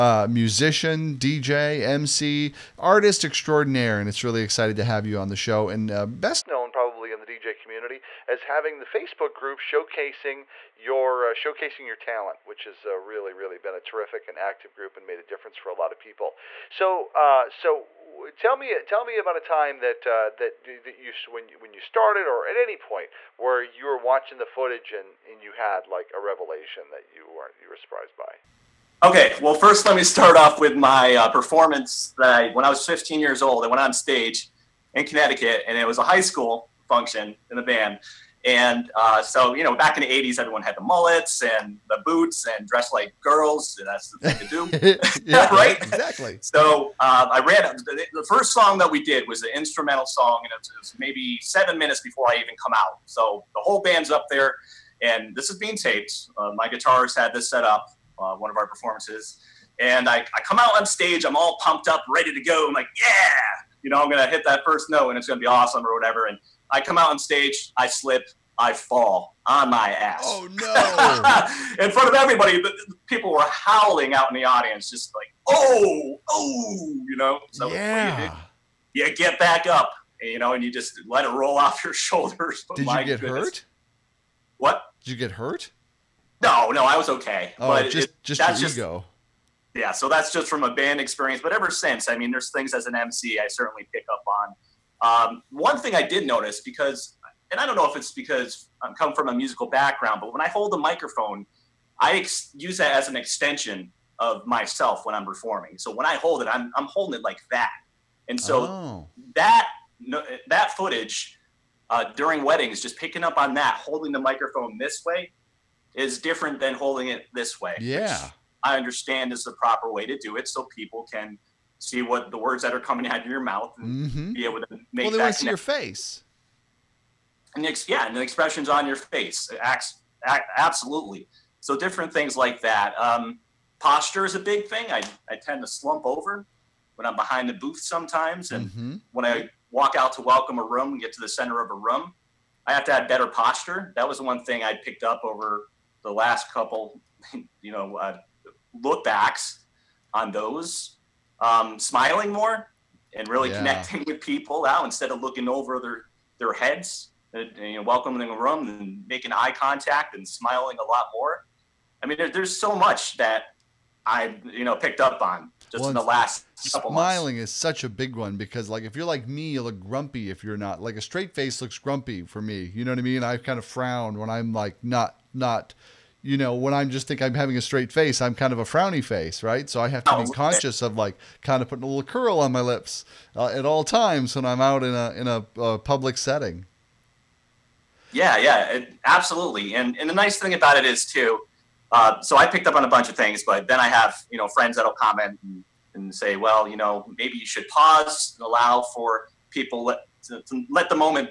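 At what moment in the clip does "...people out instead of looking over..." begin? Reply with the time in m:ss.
2:34.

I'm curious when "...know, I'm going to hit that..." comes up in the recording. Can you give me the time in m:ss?
1:03.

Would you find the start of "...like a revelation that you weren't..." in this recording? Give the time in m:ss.
0:25.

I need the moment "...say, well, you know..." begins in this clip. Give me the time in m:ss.
3:16.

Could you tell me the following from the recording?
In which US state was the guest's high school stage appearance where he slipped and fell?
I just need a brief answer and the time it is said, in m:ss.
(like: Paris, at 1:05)
Connecticut, at 0:35.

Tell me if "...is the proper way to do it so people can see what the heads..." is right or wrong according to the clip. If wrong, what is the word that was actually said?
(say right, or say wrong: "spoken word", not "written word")
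wrong: "words", not "heads".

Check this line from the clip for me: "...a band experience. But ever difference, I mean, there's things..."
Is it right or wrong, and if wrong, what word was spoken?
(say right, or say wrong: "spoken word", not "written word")
wrong: "since", not "difference".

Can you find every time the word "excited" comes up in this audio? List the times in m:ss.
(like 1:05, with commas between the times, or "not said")
0:04.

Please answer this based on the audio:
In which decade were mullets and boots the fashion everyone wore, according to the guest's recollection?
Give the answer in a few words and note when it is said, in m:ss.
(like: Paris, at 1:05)
the 80s, at 0:40.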